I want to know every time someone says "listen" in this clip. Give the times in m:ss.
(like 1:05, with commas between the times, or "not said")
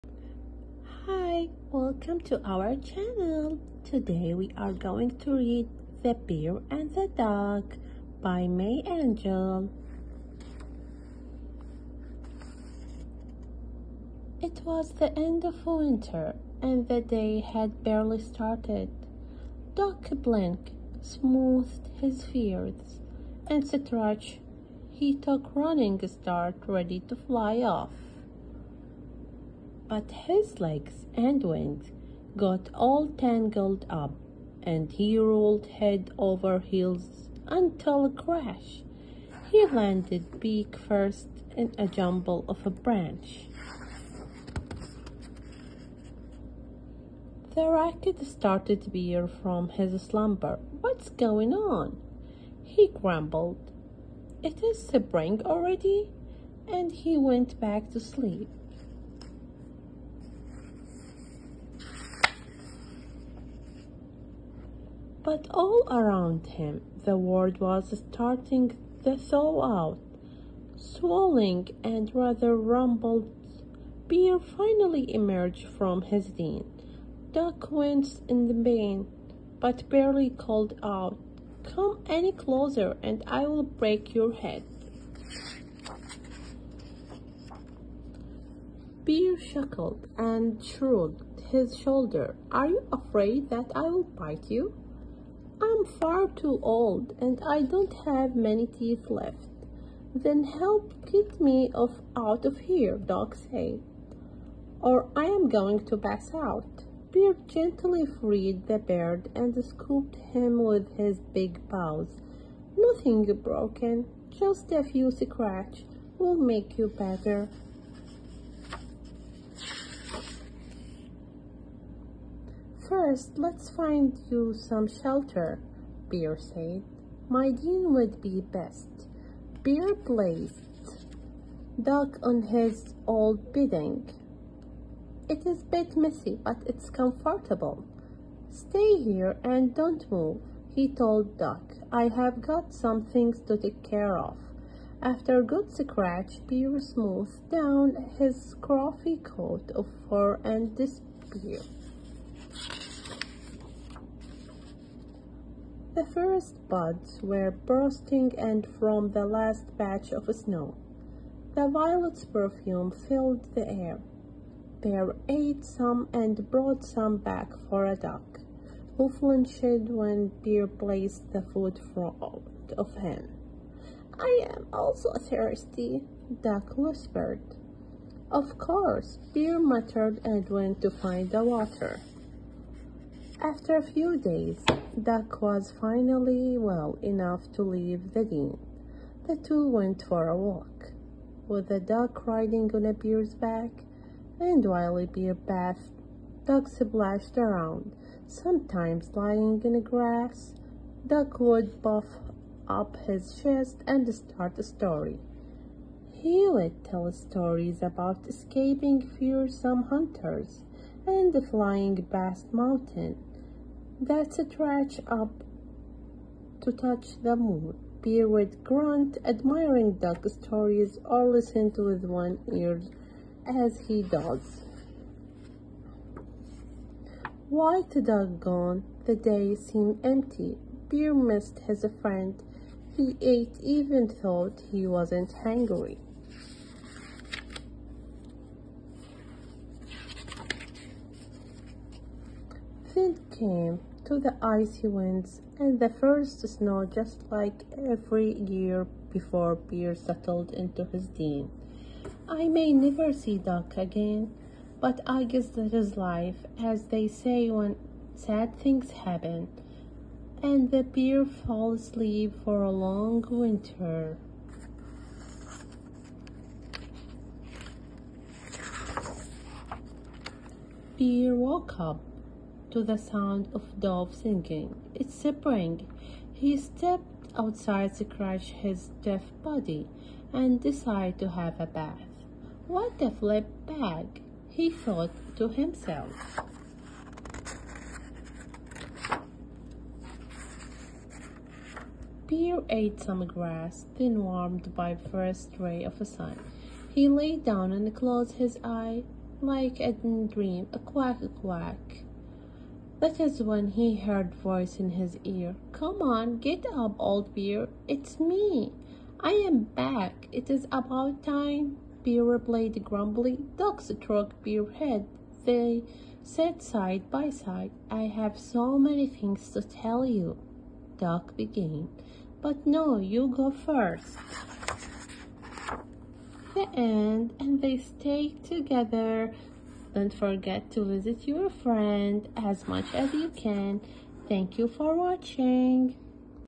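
3:41.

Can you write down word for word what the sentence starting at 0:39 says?
He landed beak first in a jumble of a branch.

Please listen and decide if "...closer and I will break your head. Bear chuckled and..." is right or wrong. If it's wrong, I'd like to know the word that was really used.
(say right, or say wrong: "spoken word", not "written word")
right.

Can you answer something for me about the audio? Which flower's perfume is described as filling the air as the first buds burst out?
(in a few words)
Violet.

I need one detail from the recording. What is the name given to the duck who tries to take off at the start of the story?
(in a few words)
Blink.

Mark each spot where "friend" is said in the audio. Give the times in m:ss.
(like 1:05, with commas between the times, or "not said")
3:52, 5:31.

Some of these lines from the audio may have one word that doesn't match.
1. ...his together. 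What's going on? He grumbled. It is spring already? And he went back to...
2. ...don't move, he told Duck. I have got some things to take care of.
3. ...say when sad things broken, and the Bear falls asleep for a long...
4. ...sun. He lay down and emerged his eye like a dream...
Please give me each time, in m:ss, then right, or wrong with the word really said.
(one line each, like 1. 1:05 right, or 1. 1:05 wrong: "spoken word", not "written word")
1. 0:49 wrong: "slumber", not "together"
2. 2:19 right
3. 4:17 wrong: "happen", not "broken"
4. 4:56 wrong: "closed", not "emerged".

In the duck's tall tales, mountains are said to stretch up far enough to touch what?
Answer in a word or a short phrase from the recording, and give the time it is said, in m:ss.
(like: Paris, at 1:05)
The moon, at 3:37.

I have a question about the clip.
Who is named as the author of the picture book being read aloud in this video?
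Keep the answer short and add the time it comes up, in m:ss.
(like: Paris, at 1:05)
May Angel, at 0:08.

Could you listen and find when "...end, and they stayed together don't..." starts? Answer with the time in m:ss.
5:26.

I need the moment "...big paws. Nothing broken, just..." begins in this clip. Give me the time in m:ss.
1:51.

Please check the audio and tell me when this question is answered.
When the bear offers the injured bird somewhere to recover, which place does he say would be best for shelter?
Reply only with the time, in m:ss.
2:07.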